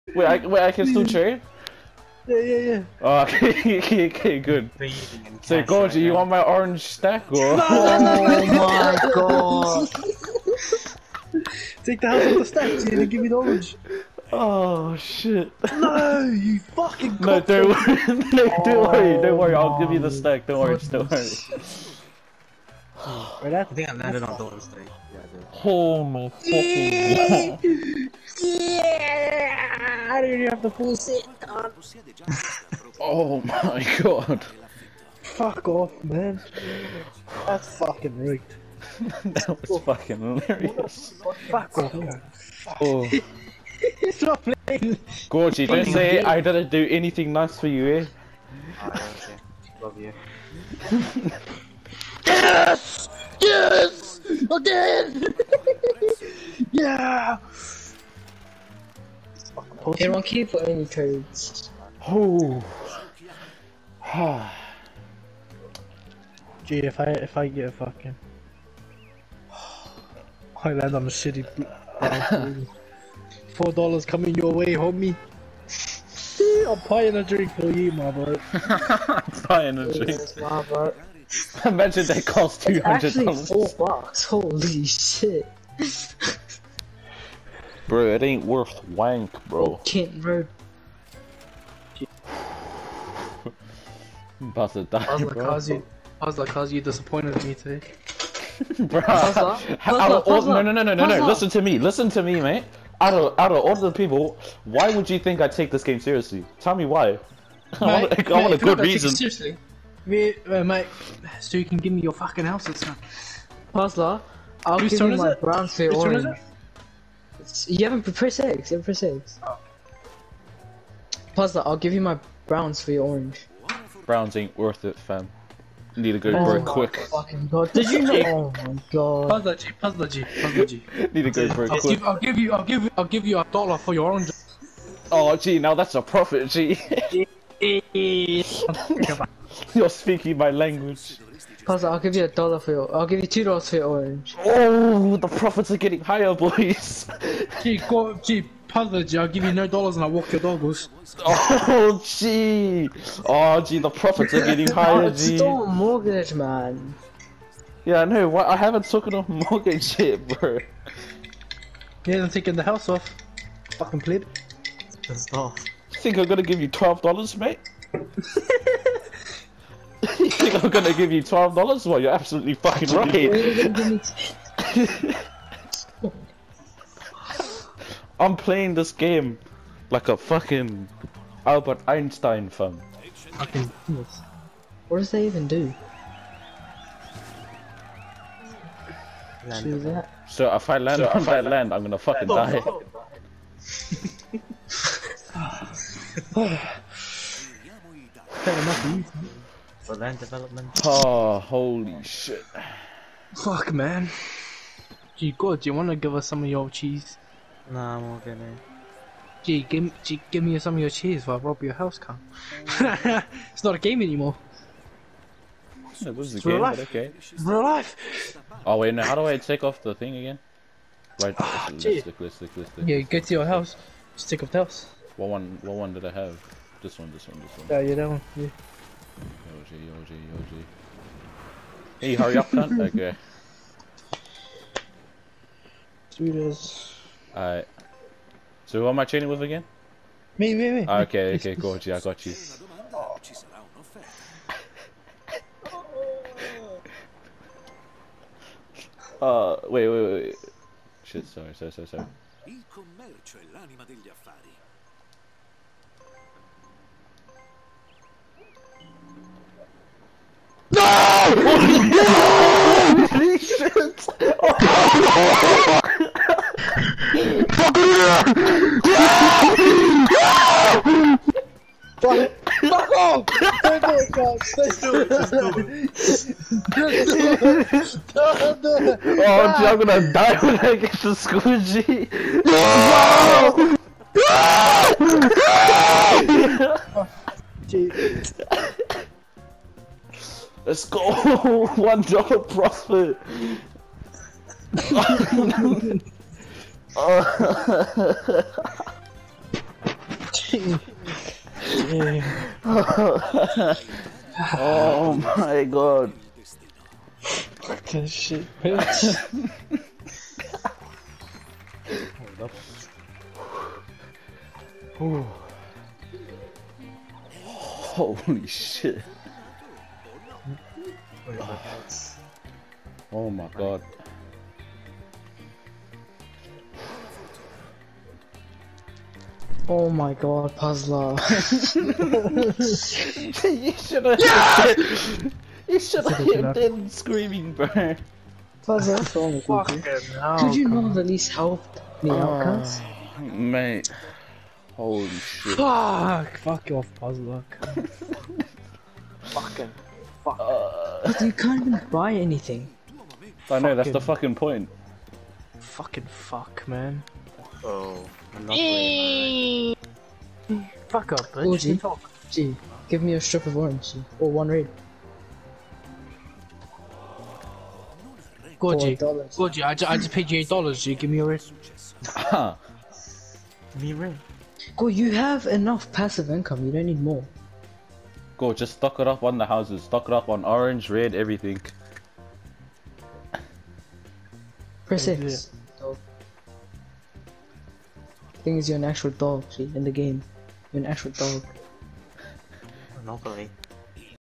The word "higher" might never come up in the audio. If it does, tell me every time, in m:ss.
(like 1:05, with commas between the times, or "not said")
2:26, 2:34.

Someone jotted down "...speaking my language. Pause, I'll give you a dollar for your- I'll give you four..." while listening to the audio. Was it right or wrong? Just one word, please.
wrong.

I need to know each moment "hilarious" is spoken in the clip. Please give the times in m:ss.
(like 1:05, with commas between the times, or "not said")
0:40.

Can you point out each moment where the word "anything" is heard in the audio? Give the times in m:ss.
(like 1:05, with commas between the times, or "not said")
0:46, 5:52.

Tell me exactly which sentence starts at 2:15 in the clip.
Oh gee, now that's a profit, gee.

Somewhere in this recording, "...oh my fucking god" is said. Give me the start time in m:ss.
0:25.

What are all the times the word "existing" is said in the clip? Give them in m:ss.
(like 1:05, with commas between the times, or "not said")
not said.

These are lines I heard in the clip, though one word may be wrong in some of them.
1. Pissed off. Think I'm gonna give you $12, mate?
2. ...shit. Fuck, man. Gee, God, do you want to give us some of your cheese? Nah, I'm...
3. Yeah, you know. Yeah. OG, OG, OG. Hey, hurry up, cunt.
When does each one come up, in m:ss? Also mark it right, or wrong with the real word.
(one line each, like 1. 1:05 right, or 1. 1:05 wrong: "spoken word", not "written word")
1. 2:45 right
2. 3:22 right
3. 3:47 right.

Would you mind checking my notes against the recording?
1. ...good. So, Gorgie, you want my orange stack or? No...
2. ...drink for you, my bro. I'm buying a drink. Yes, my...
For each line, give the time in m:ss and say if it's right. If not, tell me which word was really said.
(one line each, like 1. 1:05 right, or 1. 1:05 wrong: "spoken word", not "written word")
1. 0:04 right
2. 1:17 right.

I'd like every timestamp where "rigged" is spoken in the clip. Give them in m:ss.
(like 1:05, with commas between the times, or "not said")
0:38.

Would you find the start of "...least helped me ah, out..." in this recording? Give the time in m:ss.
5:41.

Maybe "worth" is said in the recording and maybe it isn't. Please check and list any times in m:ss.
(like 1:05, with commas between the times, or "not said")
1:28, 2:04.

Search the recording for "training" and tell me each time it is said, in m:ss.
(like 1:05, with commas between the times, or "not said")
3:59.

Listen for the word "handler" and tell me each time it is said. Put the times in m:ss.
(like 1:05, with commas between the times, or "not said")
not said.